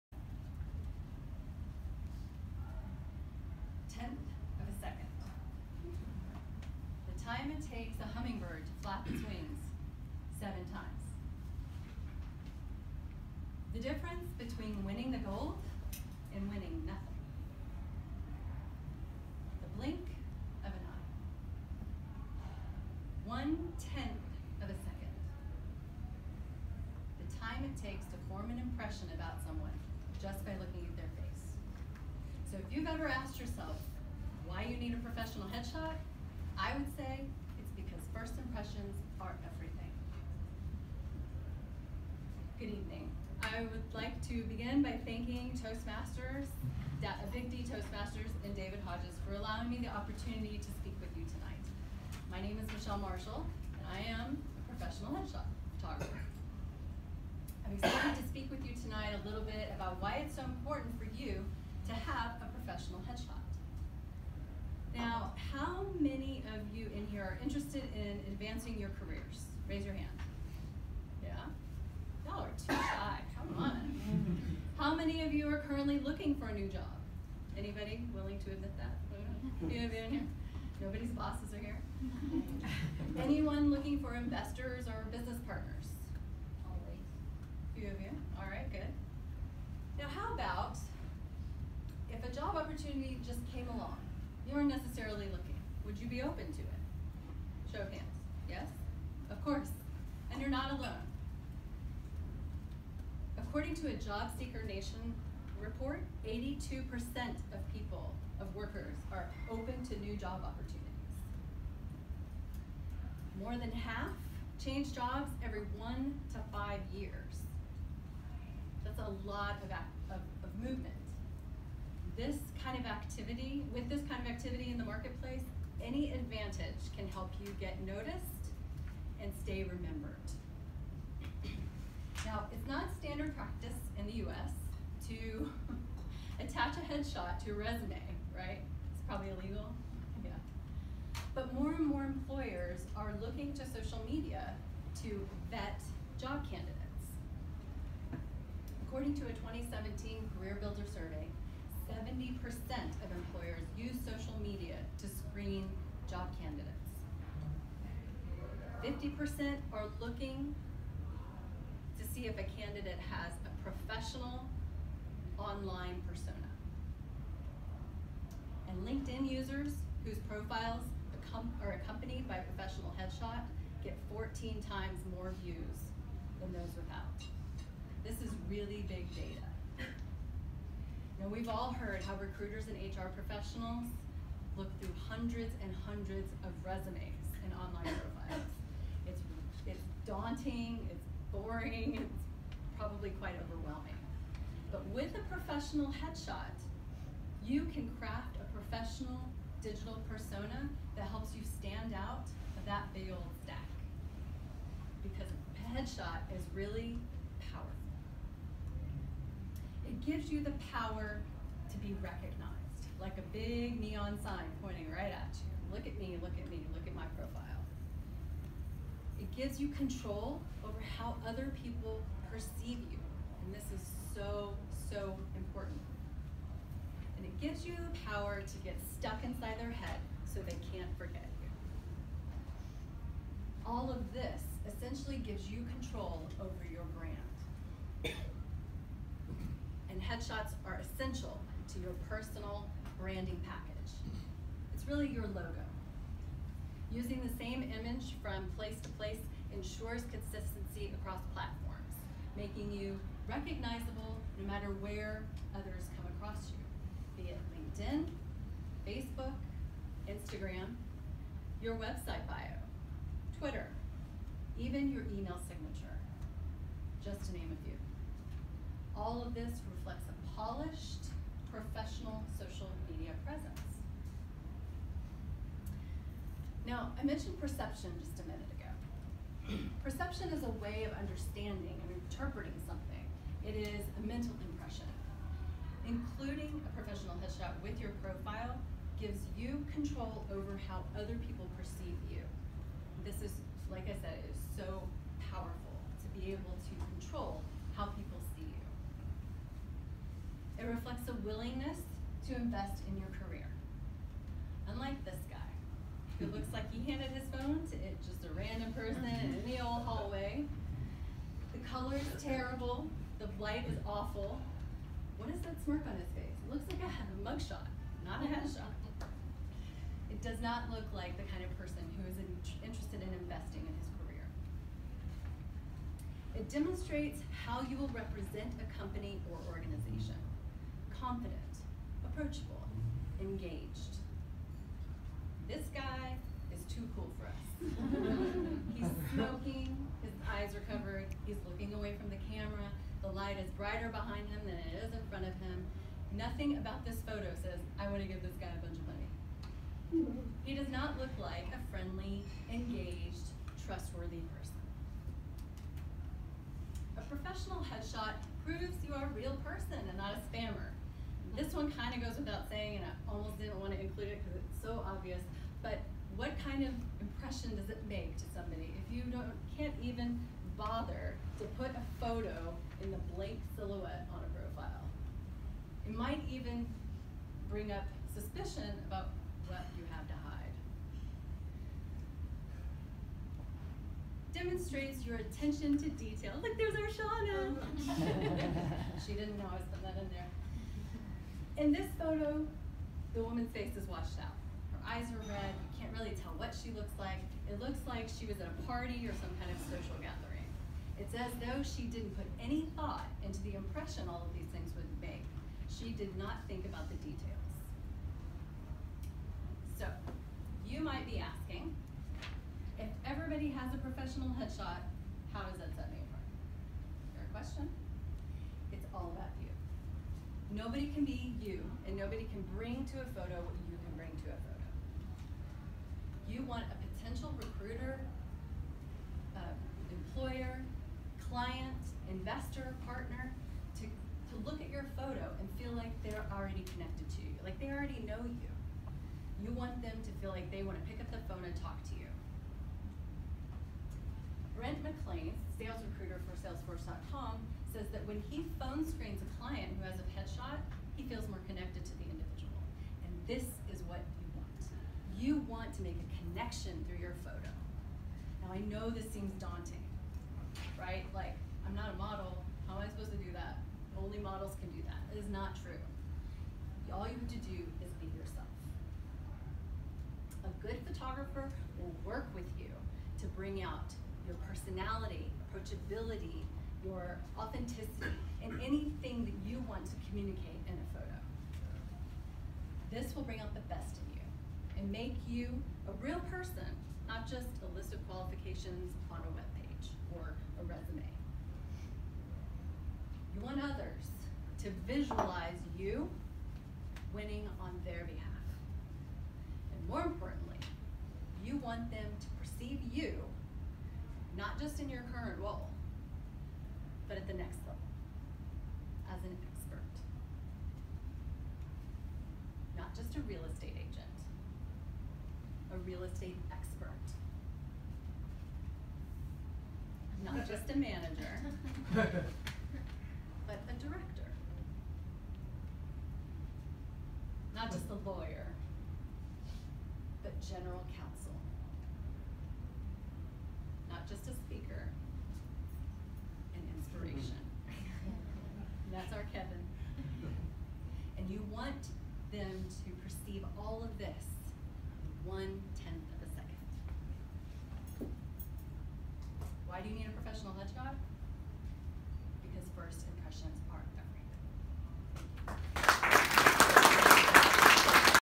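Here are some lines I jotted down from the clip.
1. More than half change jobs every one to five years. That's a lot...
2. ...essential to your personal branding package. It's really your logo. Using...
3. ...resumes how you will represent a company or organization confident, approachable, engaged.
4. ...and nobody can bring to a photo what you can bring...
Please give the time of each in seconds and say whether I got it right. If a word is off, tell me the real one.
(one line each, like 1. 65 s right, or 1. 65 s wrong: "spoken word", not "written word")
1. 113 s right
2. 240 s right
3. 326 s wrong: "demonstrates", not "resumes"
4. 421 s right.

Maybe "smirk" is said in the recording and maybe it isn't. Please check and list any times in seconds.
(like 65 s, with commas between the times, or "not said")
315 s.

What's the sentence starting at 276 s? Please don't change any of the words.
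Now, I mentioned perception just a minute ago.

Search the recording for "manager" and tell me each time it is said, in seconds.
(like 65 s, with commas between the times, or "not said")
520 s.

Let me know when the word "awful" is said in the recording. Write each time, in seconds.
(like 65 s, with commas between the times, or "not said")
313 s.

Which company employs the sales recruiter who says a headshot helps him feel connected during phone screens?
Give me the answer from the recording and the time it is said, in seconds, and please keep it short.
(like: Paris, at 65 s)
Salesforce.com, at 446 s.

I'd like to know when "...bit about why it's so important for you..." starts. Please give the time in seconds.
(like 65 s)
59 s.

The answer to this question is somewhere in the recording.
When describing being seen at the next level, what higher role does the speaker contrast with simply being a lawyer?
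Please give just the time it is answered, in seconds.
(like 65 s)
530 s.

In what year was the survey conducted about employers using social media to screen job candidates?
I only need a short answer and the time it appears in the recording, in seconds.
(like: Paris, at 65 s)
2017, at 149 s.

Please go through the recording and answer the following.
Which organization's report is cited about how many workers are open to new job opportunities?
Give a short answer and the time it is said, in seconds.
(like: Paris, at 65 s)
Job Seeker Nation, at 103 s.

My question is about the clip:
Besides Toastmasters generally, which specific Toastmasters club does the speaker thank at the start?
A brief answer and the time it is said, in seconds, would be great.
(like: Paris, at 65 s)
Big D Toastmasters, at 47 s.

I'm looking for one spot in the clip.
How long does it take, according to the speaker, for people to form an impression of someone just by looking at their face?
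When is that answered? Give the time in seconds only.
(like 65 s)
23 s.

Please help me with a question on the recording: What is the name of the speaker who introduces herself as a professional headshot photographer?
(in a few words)
Michelle Marshall.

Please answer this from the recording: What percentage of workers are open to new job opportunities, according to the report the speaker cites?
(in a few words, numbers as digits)
82%.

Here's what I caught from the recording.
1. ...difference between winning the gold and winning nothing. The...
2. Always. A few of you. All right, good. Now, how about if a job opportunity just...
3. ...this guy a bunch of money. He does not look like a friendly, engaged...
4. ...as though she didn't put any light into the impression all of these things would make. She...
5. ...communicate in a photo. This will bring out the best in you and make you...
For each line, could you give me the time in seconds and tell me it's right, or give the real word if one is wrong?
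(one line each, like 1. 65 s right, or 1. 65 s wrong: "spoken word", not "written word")
1. 13 s right
2. 86 s right
3. 348 s right
4. 401 s wrong: "thought", not "light"
5. 480 s right.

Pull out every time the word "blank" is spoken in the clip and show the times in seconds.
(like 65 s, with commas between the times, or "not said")
373 s.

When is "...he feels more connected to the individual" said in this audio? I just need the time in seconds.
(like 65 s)
450 s.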